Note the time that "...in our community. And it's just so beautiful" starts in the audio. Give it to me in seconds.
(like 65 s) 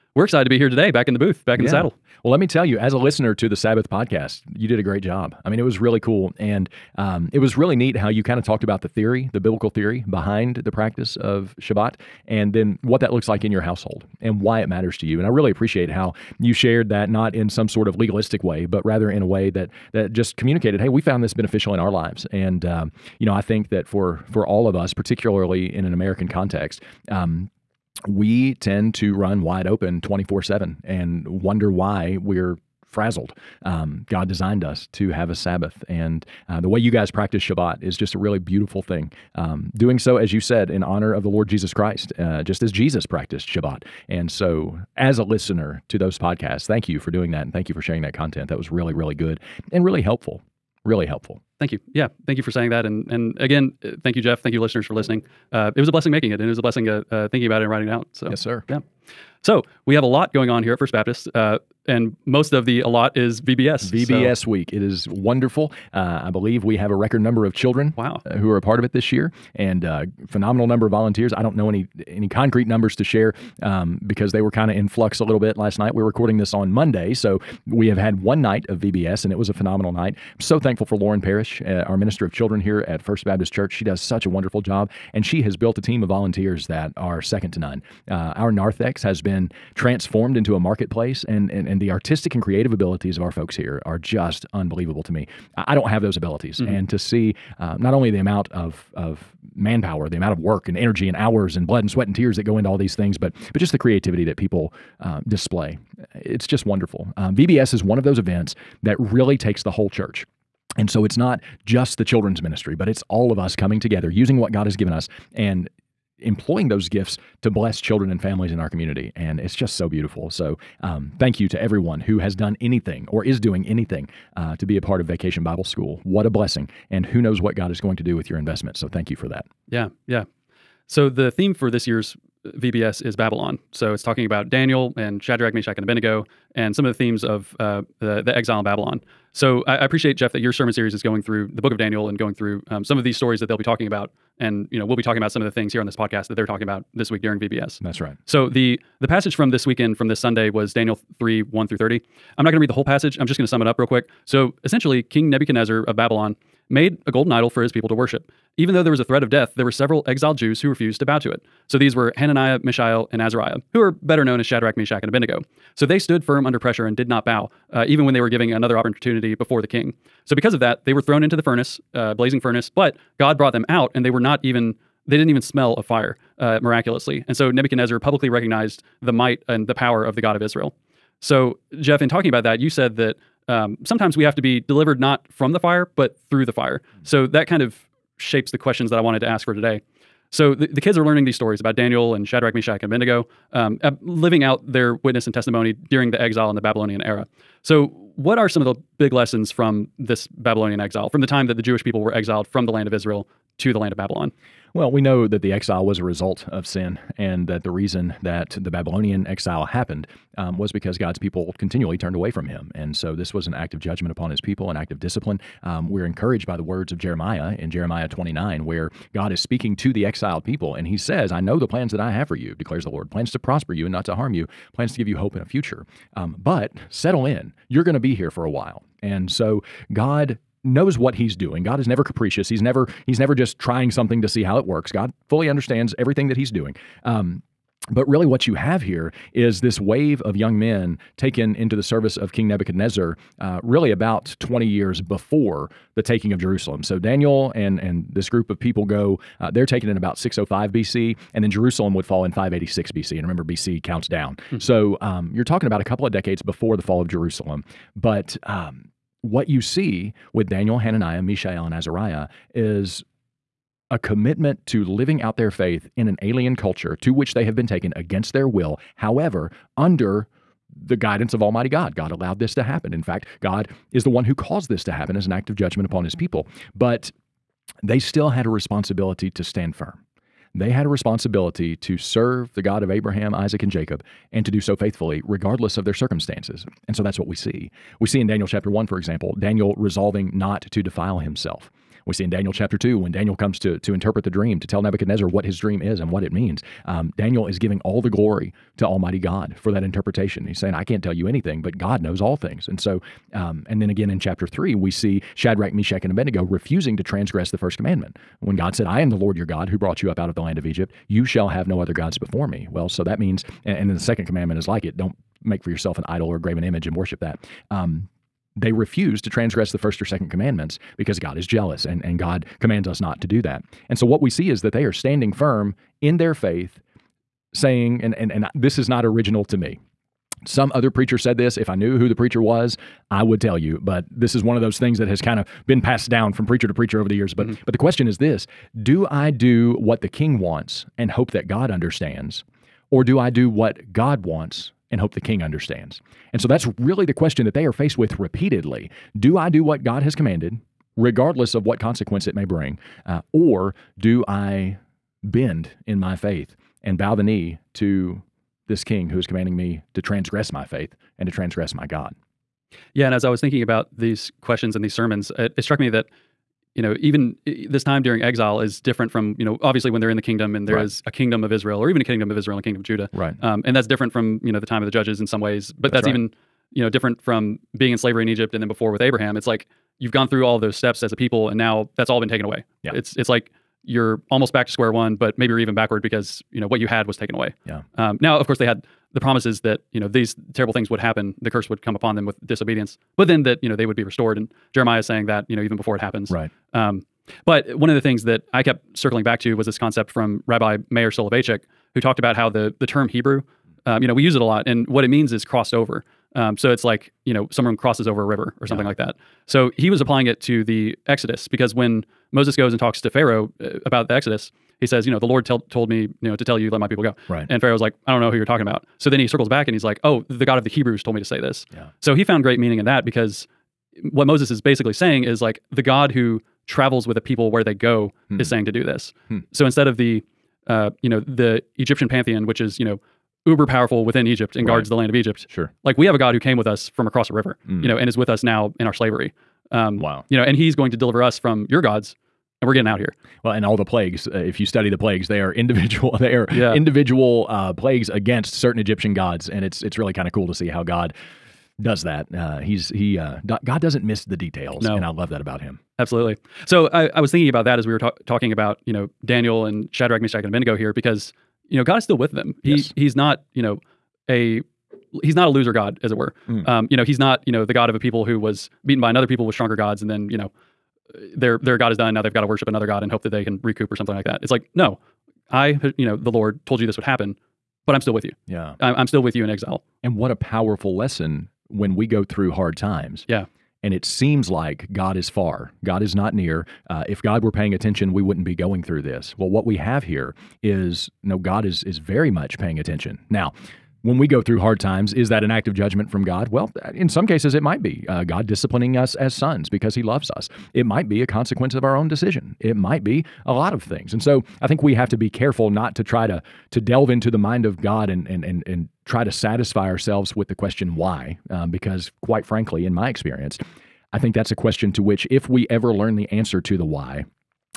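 118 s.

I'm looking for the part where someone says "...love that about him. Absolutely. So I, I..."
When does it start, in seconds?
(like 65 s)
455 s.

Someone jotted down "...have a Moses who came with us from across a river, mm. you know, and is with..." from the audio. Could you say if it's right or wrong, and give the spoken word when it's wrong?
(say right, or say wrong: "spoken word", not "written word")
wrong: "God", not "Moses".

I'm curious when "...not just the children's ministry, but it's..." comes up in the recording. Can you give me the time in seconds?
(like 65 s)
111 s.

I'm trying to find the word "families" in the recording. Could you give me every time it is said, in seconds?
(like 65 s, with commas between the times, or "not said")
118 s.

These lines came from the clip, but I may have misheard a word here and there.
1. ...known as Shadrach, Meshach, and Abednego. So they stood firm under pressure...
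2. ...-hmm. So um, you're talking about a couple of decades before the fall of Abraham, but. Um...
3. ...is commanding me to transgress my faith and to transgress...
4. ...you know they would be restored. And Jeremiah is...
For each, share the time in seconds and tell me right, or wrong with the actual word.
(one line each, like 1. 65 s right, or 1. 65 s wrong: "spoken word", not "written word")
1. 164 s right
2. 254 s wrong: "Jerusalem", not "Abraham"
3. 359 s right
4. 393 s right.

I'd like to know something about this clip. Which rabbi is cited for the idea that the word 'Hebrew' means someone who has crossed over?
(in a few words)
Meir Soloveitchik.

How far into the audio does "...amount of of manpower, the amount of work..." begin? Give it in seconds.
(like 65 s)
98 s.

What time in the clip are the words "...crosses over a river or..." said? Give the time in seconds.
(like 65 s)
407 s.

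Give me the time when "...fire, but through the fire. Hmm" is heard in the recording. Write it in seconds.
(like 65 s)
185 s.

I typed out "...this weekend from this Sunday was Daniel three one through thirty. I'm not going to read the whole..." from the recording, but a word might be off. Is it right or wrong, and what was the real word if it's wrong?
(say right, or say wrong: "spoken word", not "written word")
right.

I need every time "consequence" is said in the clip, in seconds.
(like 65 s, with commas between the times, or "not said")
351 s, 501 s.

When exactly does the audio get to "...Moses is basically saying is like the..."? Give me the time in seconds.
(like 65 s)
424 s.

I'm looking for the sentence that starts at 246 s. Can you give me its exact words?
So Daniel and and this group of people go.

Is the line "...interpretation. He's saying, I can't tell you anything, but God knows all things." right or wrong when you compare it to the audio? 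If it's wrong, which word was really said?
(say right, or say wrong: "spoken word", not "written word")
right.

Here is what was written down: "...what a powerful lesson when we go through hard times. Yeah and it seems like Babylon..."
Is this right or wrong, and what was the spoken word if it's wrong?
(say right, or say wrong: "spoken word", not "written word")
wrong: "God", not "Babylon".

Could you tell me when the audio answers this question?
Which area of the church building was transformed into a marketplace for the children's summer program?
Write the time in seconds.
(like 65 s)
88 s.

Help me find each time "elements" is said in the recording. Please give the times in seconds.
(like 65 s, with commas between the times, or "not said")
not said.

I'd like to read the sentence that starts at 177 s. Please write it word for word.
And so Nebuchadnezzar publicly recognized the might and the power of the God of Israel.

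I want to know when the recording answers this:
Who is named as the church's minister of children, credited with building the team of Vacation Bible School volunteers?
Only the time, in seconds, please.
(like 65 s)
80 s.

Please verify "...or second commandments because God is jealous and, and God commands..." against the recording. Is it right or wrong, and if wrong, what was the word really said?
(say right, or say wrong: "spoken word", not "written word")
right.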